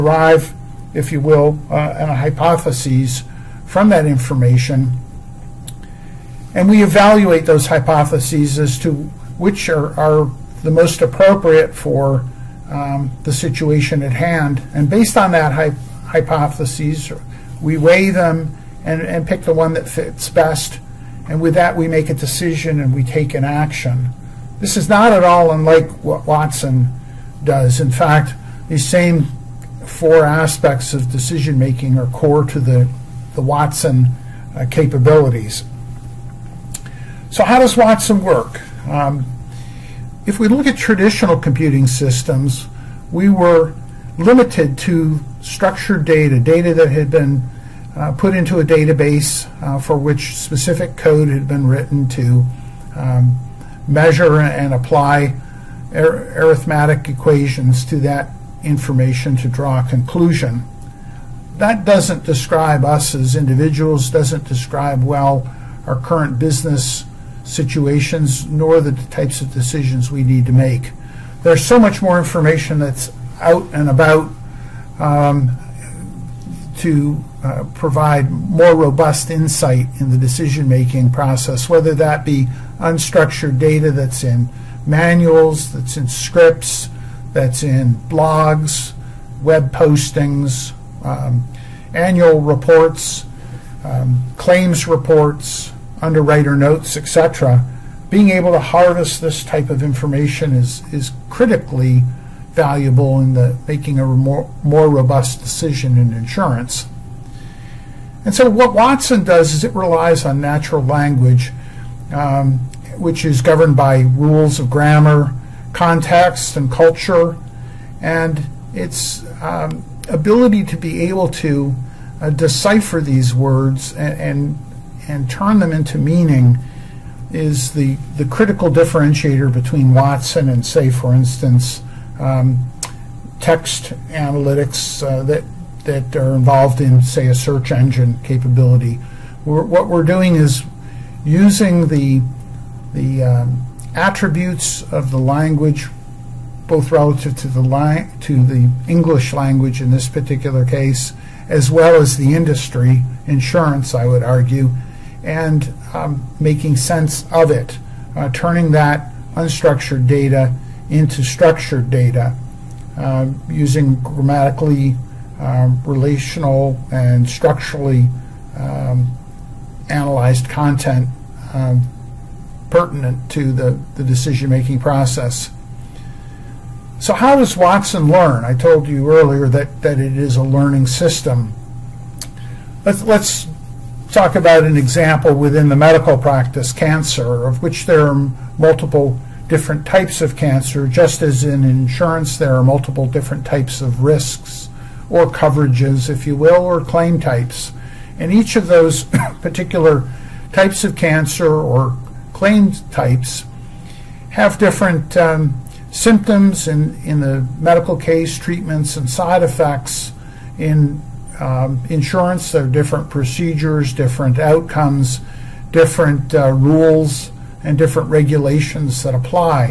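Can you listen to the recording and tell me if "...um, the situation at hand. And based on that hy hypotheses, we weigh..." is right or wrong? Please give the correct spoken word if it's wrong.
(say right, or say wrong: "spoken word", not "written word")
right.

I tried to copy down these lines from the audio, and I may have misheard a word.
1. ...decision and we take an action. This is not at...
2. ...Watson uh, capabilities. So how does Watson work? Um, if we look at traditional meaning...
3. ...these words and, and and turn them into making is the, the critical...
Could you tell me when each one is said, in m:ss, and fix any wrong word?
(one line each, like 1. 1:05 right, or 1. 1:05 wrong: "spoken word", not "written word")
1. 0:22 right
2. 0:33 wrong: "computing", not "meaning"
3. 2:02 wrong: "meaning", not "making".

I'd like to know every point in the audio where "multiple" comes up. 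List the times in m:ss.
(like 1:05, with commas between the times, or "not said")
3:08, 3:12.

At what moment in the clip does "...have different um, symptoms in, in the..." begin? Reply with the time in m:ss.
3:24.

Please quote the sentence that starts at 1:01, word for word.
That doesn't describe us as individuals, doesn't describe well our current business situations nor the types of decisions we need to make.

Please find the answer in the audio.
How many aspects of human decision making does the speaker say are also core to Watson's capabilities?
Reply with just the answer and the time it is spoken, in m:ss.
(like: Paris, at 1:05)
4, at 0:29.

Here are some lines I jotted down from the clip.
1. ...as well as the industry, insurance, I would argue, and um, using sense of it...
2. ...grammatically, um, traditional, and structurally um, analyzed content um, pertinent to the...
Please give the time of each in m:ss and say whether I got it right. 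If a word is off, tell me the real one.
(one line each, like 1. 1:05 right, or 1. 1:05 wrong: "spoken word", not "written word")
1. 2:31 wrong: "making", not "using"
2. 2:43 wrong: "relational", not "traditional".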